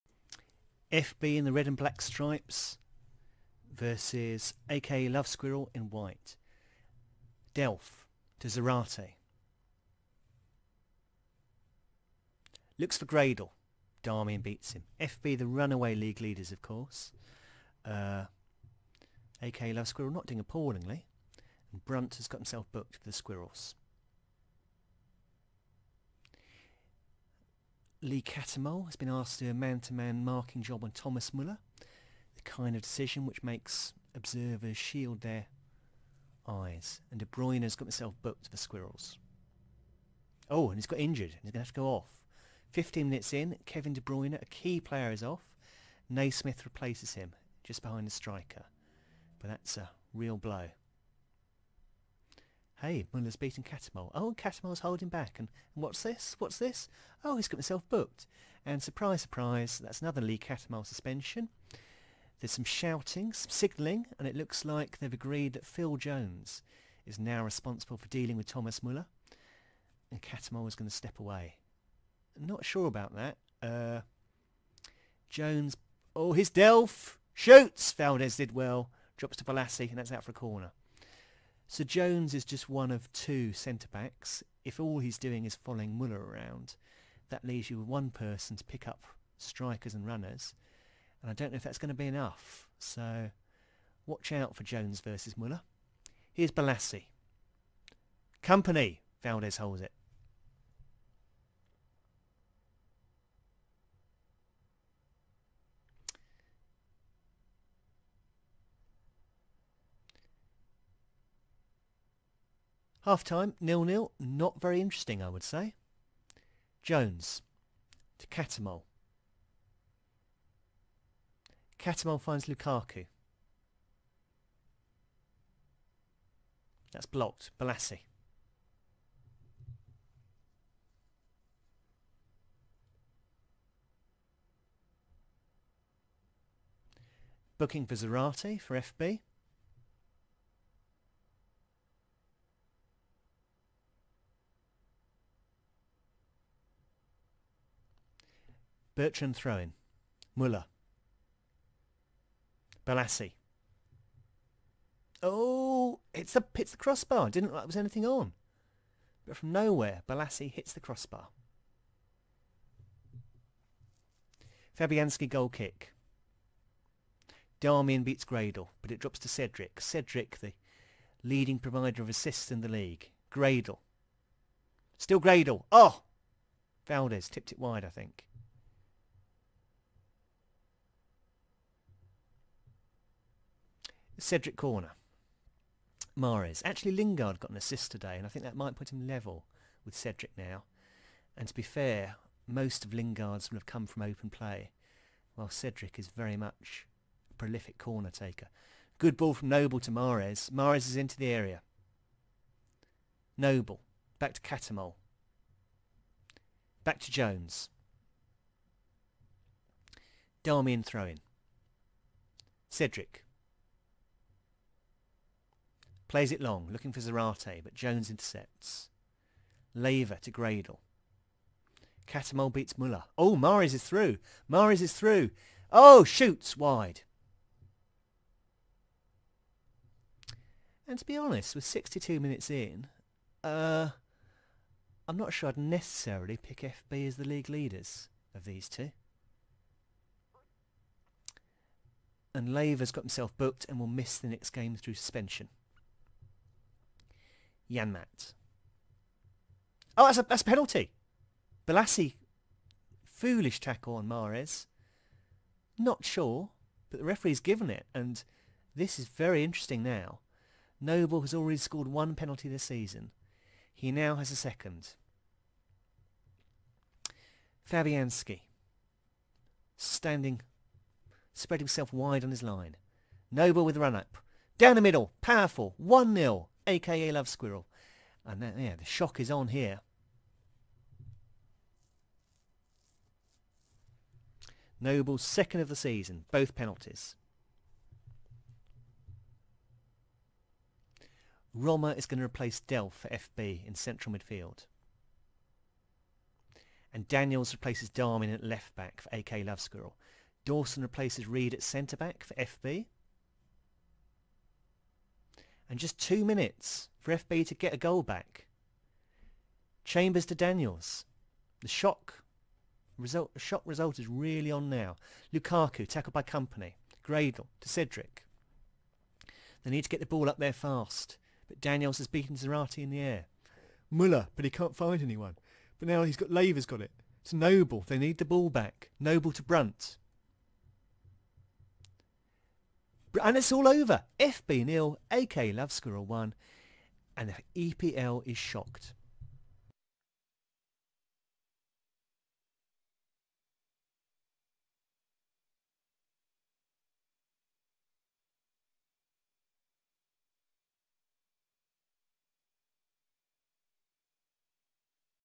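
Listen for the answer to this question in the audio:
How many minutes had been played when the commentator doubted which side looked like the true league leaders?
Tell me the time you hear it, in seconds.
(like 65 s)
231 s.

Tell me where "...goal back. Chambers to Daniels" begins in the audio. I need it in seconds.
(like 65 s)
307 s.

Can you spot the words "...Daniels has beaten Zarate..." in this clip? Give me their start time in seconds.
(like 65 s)
321 s.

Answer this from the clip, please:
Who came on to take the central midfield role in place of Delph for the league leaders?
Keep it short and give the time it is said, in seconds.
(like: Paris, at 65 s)
Roma, at 291 s.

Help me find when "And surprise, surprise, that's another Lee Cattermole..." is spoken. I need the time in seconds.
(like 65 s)
58 s.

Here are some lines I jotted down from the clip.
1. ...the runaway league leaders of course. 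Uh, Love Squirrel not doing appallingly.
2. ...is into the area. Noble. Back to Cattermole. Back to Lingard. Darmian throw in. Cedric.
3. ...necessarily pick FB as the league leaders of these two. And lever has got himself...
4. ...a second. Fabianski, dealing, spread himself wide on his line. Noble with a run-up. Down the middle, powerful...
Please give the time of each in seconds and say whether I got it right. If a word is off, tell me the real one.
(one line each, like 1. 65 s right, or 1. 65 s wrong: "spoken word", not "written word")
1. 15 s right
2. 200 s wrong: "Jones", not "Lingard"
3. 235 s right
4. 264 s wrong: "standing", not "dealing".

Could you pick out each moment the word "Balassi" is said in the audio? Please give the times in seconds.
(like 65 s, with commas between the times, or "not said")
79 s, 96 s, 127 s, 152 s, 160 s, 251 s.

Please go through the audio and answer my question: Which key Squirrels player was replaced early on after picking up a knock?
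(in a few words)
Kevin De Bruyne.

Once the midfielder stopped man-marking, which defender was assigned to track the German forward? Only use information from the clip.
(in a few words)
Phil Jones.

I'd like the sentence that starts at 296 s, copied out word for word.
And Daniels replaces Darwin at left back for AK Love Squirrel.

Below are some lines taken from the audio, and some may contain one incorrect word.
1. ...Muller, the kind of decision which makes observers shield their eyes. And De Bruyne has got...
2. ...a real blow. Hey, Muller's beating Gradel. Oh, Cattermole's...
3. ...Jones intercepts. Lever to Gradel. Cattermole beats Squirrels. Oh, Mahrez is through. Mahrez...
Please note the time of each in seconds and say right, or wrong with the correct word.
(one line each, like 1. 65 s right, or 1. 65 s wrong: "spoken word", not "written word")
1. 31 s right
2. 49 s wrong: "Cattermole", not "Gradel"
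3. 217 s wrong: "Muller", not "Squirrels".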